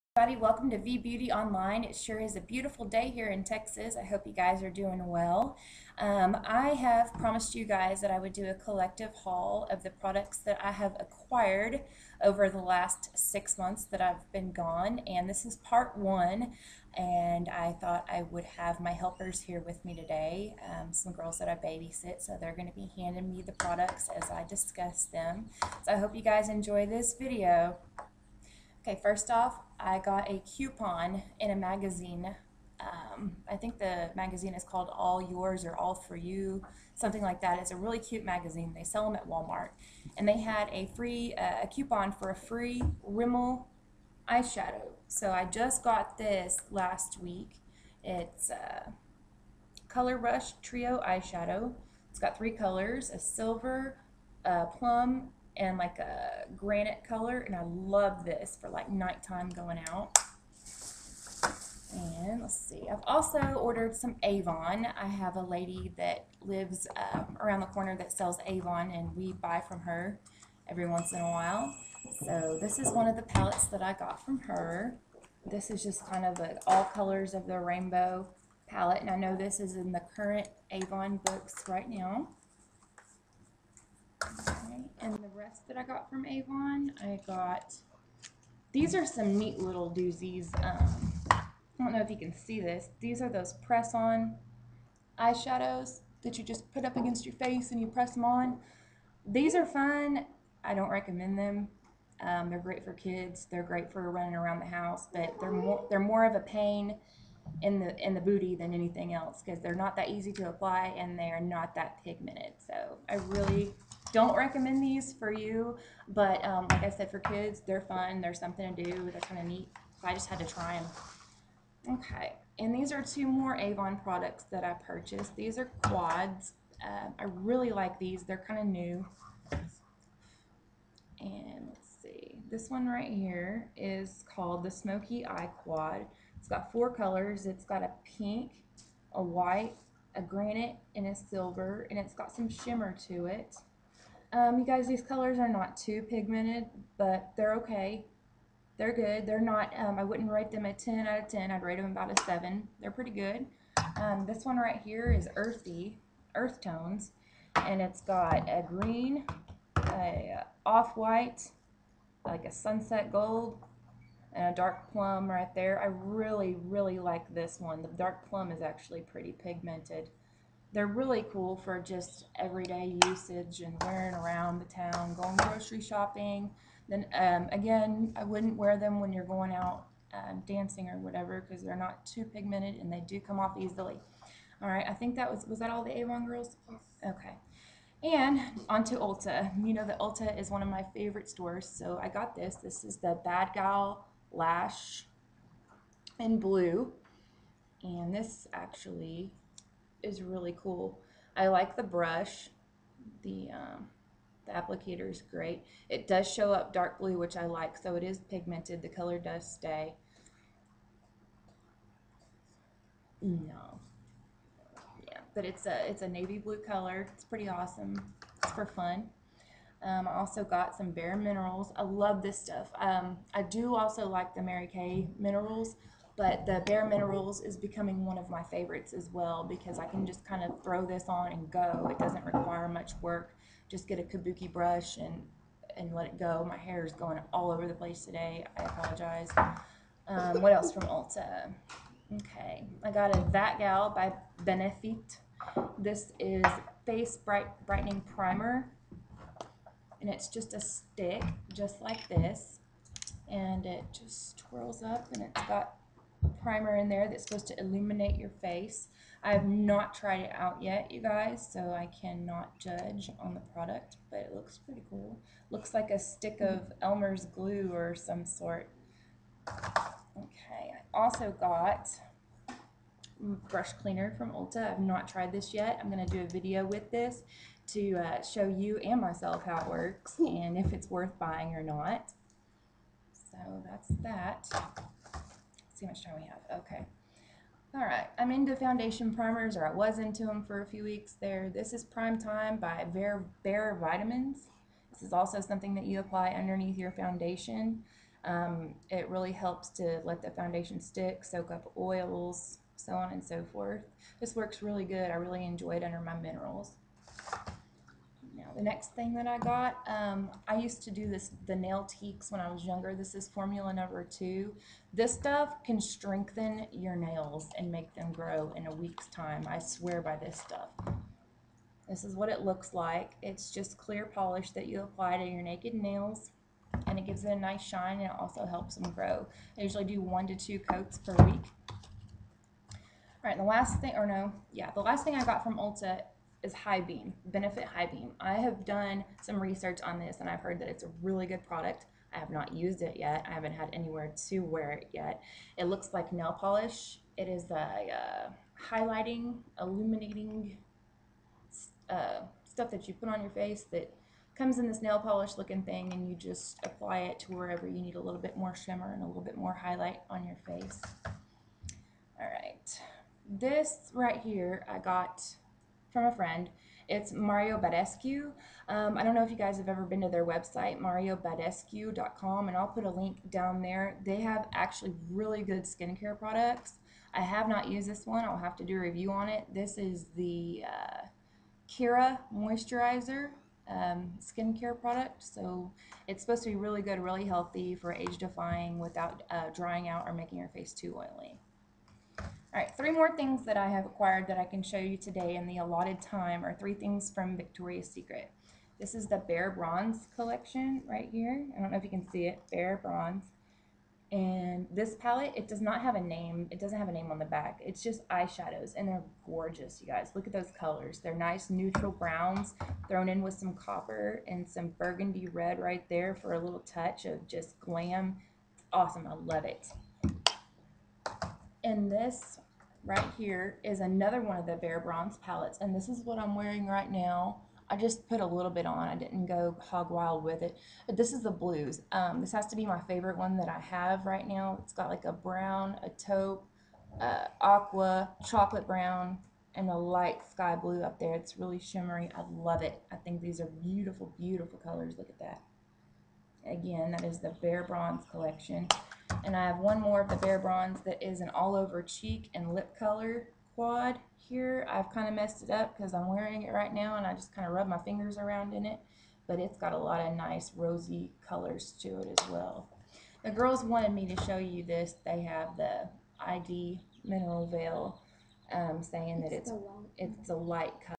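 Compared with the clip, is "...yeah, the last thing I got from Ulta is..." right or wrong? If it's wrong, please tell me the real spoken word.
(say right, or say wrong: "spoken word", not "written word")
right.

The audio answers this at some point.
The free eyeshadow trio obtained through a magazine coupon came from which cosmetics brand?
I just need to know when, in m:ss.
0:43.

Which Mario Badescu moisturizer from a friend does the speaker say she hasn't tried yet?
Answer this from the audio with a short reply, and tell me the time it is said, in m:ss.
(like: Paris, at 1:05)
Kira Moisturizer, at 6:21.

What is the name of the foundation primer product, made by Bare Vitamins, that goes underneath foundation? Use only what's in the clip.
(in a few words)
Prime Time.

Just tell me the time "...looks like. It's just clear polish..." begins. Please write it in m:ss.
5:22.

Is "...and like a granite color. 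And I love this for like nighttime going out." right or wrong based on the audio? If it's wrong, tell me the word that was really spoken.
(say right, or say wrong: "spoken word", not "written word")
right.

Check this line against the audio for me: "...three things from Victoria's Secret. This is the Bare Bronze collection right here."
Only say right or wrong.
right.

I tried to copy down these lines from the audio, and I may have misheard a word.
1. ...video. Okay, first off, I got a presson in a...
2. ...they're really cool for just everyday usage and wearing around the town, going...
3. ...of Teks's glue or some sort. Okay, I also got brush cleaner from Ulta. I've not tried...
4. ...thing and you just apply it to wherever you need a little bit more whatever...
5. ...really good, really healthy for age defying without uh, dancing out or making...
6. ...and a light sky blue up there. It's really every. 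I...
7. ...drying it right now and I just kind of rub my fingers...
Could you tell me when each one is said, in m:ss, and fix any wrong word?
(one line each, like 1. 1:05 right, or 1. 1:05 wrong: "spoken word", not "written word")
1. 0:27 wrong: "coupon", not "presson"
2. 2:50 right
3. 4:26 wrong: "Elmer", not "Teks"
4. 5:55 wrong: "shimmer", not "whatever"
5. 6:26 wrong: "drying", not "dancing"
6. 7:19 wrong: "shimmery", not "every"
7. 7:36 wrong: "wearing", not "drying".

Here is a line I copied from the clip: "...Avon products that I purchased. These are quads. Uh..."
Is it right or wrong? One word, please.
right.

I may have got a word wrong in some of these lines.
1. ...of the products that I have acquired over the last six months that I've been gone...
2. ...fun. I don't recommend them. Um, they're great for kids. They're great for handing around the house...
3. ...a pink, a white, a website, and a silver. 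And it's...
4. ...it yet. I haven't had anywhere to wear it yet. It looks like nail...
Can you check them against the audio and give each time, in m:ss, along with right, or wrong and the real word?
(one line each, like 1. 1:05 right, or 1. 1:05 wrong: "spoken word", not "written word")
1. 0:09 right
2. 1:39 wrong: "running", not "handing"
3. 2:17 wrong: "granite", not "website"
4. 5:42 right.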